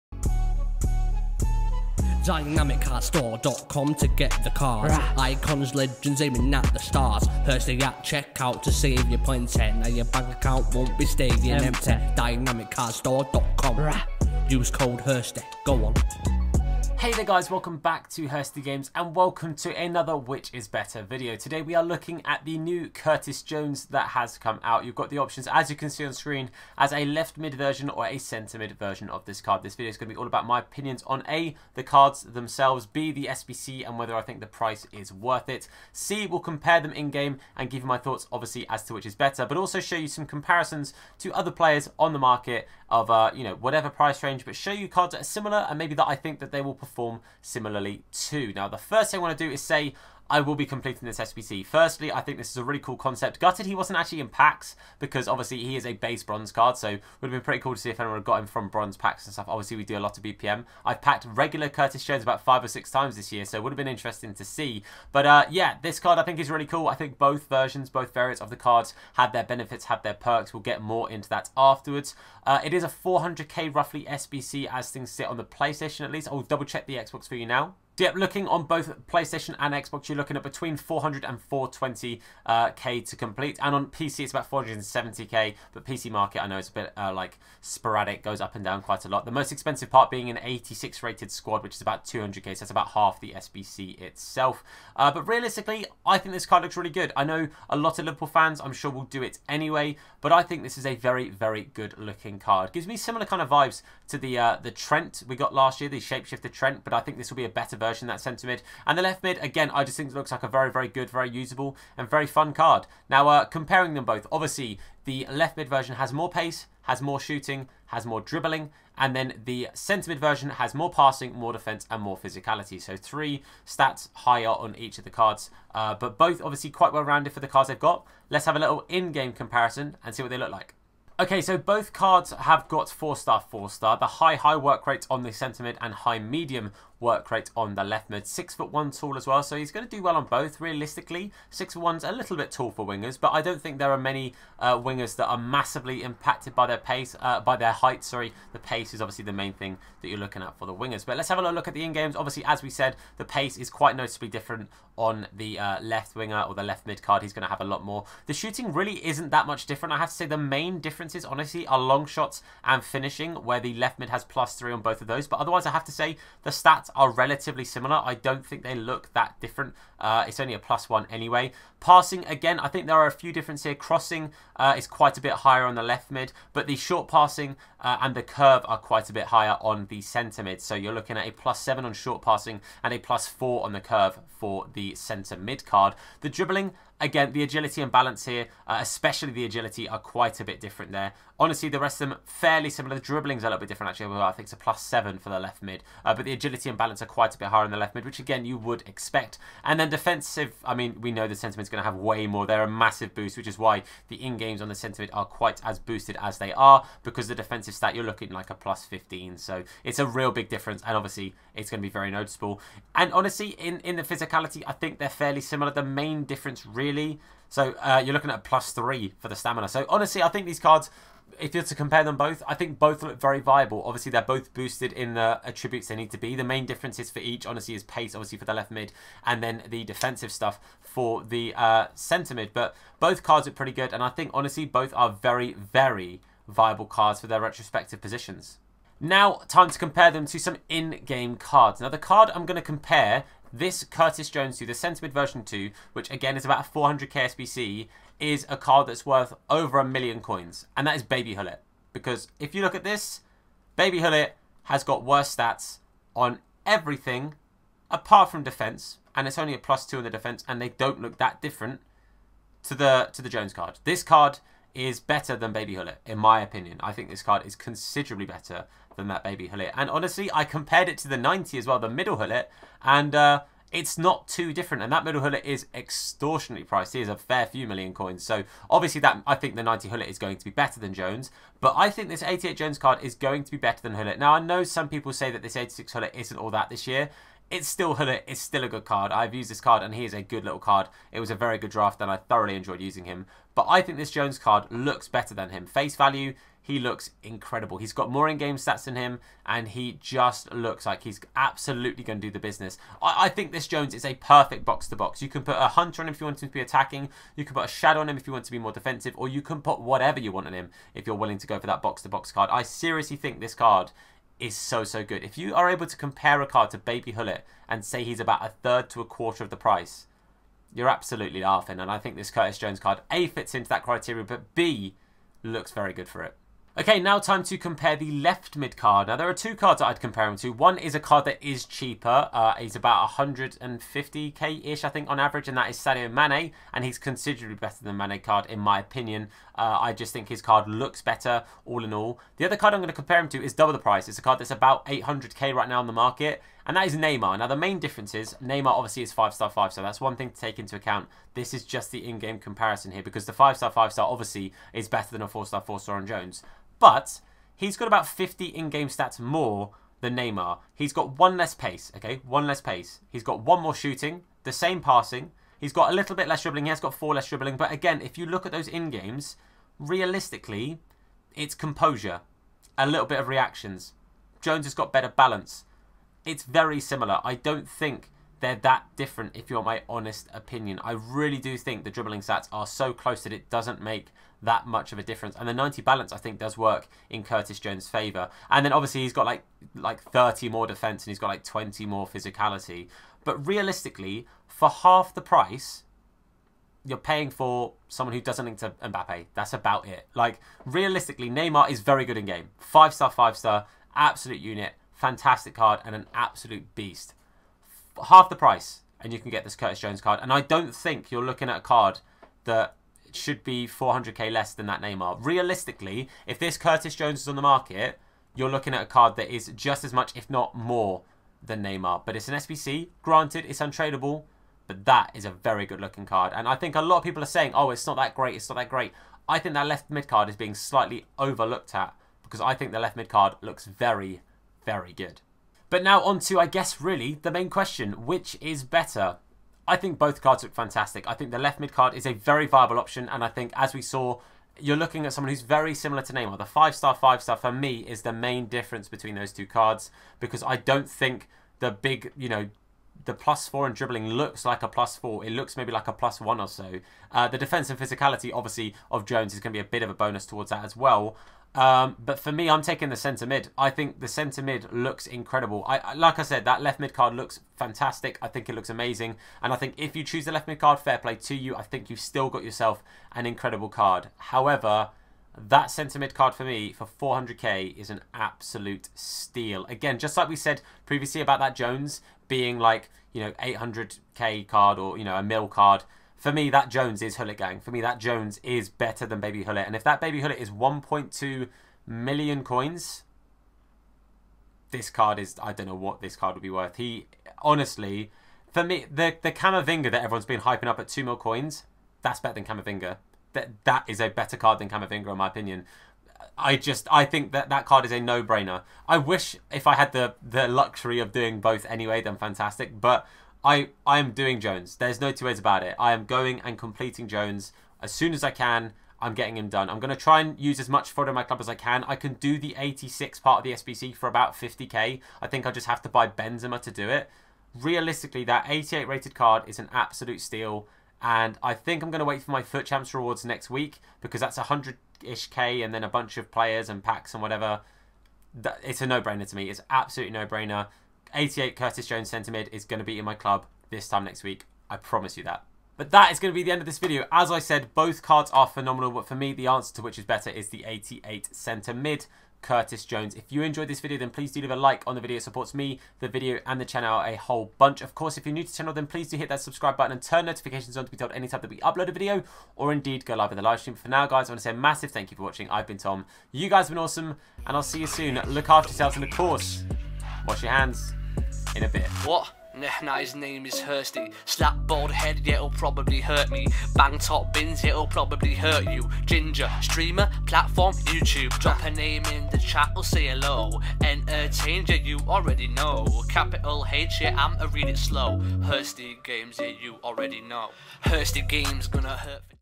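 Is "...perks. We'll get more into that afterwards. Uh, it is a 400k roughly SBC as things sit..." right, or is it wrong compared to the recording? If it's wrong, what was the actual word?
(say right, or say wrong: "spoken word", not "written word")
right.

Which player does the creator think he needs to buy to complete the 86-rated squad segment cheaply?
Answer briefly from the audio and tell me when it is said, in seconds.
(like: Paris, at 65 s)
Benzema, at 526 s.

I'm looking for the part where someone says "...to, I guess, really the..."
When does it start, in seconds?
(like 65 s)
436 s.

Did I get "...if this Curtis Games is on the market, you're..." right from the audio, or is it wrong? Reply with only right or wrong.
wrong.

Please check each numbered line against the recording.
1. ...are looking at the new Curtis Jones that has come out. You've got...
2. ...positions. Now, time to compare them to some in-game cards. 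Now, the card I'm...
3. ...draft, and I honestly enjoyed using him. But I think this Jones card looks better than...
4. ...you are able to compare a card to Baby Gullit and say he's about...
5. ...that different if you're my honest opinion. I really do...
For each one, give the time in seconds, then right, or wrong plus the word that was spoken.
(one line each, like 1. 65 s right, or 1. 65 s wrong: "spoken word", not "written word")
1. 21 s right
2. 237 s right
3. 291 s wrong: "thoroughly", not "honestly"
4. 315 s right
5. 378 s right.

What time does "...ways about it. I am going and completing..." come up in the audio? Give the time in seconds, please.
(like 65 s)
515 s.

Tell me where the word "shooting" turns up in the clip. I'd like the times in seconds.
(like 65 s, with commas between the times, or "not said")
117 s, 158 s, 363 s.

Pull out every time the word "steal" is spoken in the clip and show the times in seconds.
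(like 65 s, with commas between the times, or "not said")
478 s, 530 s.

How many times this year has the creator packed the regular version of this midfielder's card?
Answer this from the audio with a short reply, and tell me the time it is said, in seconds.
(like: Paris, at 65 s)
5 or 6, at 62 s.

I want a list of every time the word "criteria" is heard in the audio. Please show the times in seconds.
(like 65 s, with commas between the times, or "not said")
323 s.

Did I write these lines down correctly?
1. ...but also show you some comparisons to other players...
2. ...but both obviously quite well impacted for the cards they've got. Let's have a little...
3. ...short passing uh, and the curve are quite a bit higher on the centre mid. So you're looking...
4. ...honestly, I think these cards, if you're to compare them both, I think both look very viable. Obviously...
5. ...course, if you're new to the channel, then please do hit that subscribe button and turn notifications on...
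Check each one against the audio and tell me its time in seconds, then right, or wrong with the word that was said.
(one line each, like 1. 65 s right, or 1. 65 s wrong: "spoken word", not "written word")
1. 39 s right
2. 125 s wrong: "rounded", not "impacted"
3. 176 s right
4. 219 s right
5. 557 s right.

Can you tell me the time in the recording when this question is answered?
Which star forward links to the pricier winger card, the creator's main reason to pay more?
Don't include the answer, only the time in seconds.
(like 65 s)
398 s.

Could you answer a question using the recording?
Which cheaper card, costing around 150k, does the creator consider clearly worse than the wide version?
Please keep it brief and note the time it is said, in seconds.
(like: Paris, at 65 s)
Sadio Mane, at 335 s.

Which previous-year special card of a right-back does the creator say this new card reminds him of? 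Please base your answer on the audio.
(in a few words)
Shapeshifter Trent.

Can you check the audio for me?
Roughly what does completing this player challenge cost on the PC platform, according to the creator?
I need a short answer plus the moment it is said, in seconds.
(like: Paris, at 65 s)
470k, at 84 s.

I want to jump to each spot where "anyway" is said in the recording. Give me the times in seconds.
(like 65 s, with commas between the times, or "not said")
99 s, 171 s, 511 s.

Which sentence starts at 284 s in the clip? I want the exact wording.
Now, I know some people say that this 86 Gullit isn't all that this year it's still Hullet.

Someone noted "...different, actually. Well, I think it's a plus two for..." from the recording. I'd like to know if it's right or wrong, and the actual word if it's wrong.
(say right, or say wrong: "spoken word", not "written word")
wrong: "seven", not "two".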